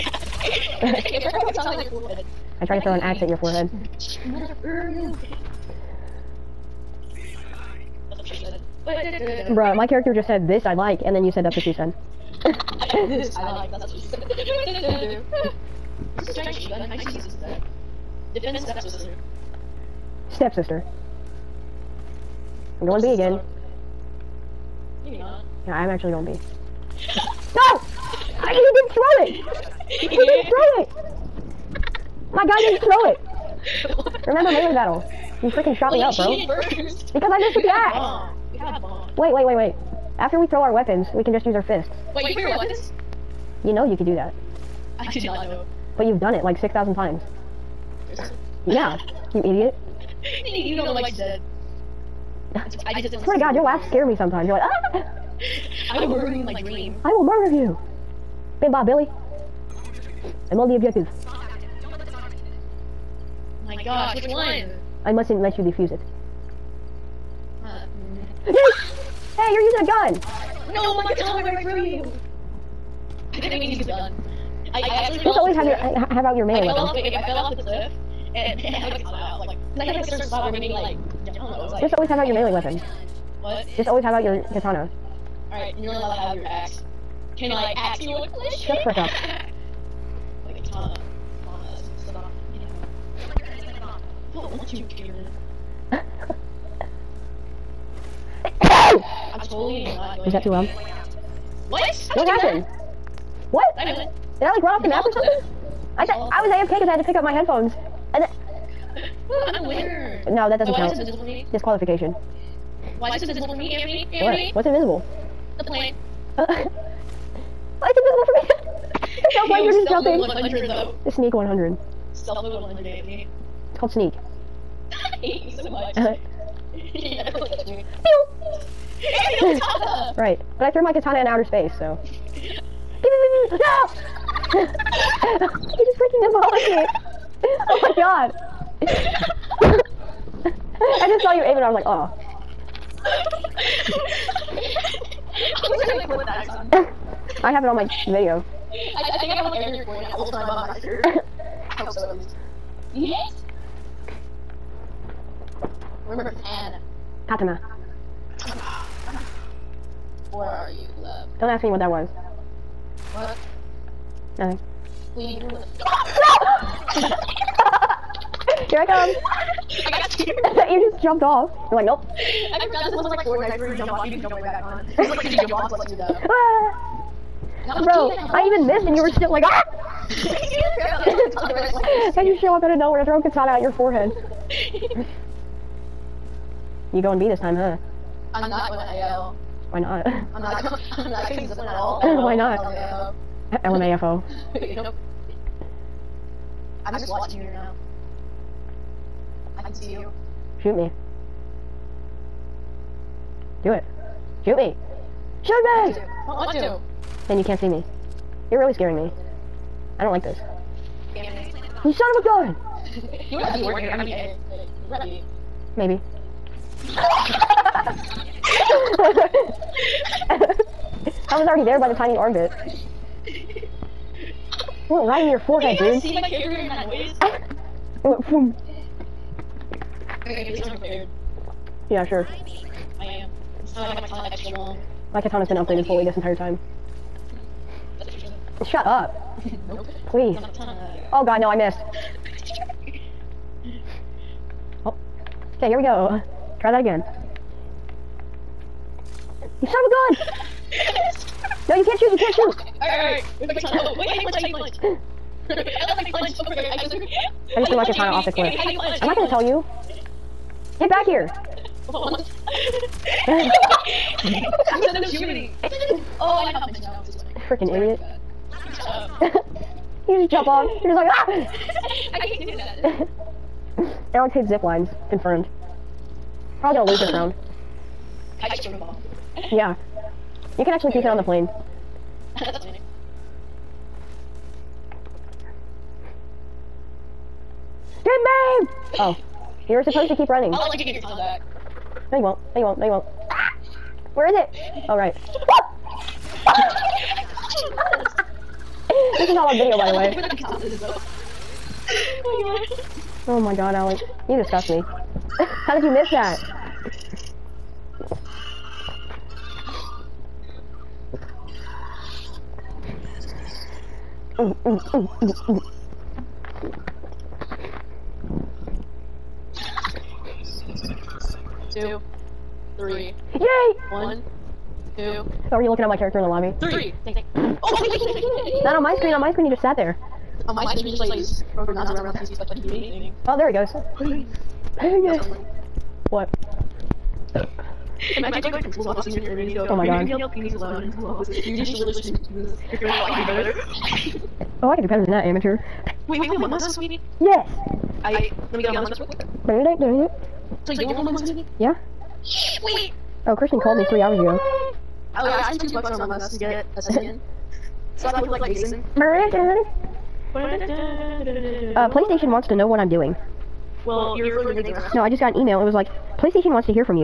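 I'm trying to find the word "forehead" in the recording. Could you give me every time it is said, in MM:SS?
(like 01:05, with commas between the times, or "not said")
00:03, 03:03, 03:45.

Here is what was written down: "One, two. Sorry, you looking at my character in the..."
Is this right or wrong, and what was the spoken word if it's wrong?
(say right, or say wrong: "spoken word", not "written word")
right.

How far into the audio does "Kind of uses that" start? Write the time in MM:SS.
00:16.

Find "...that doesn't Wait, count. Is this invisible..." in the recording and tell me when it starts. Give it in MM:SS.
01:50.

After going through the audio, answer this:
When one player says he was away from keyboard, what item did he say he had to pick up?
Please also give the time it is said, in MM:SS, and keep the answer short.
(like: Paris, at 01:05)
headphones, at 01:47.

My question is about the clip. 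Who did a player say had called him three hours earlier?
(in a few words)
Kristen.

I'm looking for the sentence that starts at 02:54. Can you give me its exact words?
It's like, like you jump off, like, like you know.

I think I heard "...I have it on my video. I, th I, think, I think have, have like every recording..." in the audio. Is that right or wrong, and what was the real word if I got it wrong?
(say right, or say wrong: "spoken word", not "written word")
right.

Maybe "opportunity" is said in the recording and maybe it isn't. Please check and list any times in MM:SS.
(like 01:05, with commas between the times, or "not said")
not said.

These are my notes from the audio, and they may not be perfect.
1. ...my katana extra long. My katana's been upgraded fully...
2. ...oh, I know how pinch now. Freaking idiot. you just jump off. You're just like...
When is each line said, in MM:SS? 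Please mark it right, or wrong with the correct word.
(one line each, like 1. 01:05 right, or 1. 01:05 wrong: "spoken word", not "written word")
1. 03:54 right
2. 04:26 right.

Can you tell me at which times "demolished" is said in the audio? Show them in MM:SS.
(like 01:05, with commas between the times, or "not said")
02:16.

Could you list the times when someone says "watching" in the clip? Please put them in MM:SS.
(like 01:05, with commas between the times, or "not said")
03:17.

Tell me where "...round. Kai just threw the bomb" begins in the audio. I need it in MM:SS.
04:37.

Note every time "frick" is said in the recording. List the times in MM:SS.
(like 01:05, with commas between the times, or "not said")
01:28, 04:16.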